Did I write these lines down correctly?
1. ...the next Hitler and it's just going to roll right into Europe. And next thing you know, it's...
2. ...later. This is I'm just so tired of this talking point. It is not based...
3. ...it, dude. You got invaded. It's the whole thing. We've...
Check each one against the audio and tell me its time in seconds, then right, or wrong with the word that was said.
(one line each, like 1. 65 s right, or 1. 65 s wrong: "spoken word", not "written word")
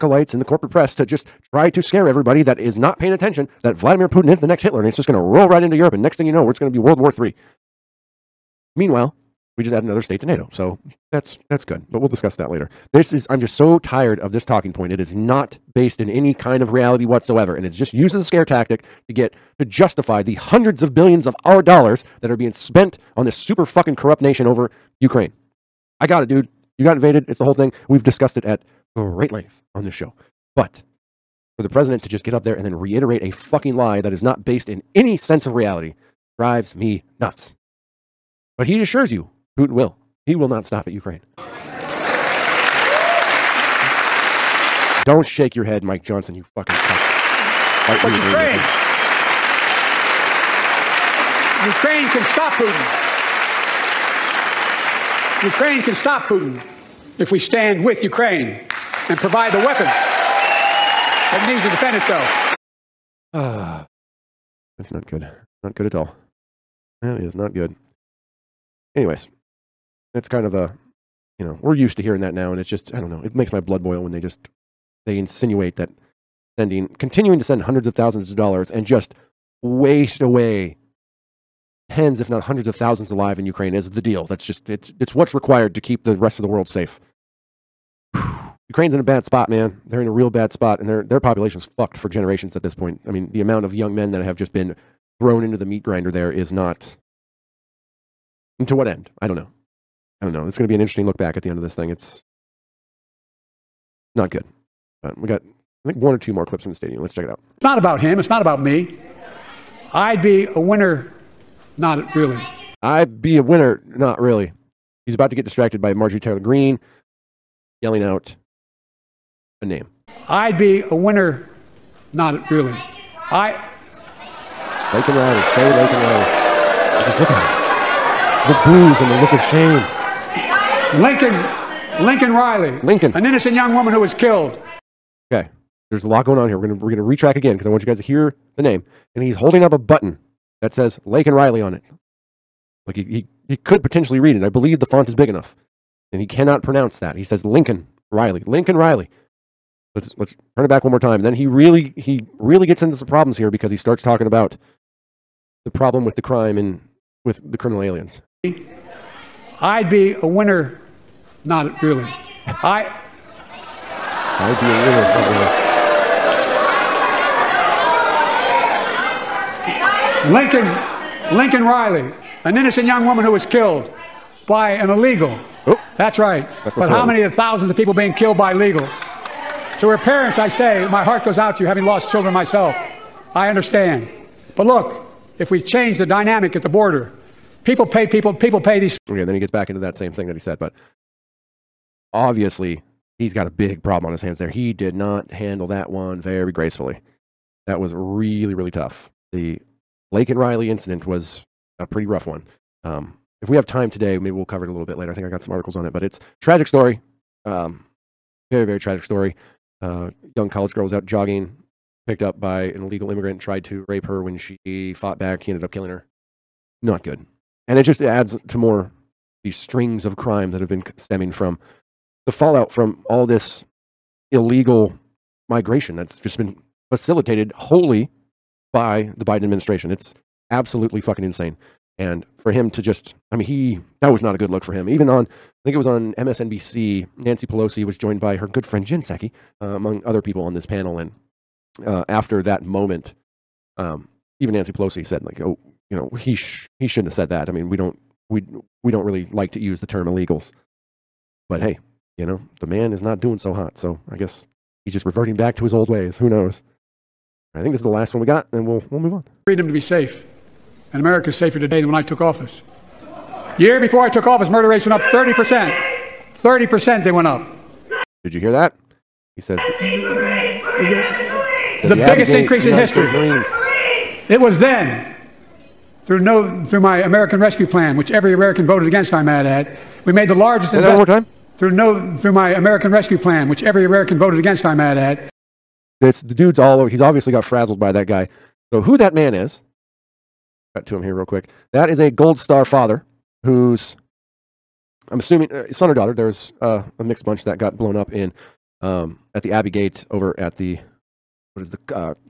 1. 4 s right
2. 12 s right
3. 26 s right.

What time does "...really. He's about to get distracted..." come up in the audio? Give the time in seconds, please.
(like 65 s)
114 s.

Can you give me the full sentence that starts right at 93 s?
I mean, the amount of young men that have just been thrown into the meat grinder there is not.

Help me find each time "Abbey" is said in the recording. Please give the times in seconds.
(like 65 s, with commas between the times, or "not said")
272 s, 299 s.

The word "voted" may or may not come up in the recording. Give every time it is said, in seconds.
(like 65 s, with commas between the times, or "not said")
278 s, 284 s.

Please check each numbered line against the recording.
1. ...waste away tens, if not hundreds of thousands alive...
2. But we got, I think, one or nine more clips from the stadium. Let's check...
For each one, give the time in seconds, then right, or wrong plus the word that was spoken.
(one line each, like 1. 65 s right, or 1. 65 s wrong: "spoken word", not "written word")
1. 79 s right
2. 105 s wrong: "two", not "nine".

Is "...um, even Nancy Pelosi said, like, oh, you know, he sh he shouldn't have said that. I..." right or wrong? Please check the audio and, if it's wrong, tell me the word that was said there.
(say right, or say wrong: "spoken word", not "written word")
right.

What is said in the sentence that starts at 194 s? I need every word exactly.
He did not handle that one very gracefully.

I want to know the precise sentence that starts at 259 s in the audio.
Freedom to be safe, and America is safer today than when I took office.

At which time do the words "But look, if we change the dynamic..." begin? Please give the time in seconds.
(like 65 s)
184 s.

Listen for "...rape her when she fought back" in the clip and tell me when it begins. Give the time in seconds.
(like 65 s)
213 s.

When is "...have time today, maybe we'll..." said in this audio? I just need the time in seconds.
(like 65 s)
203 s.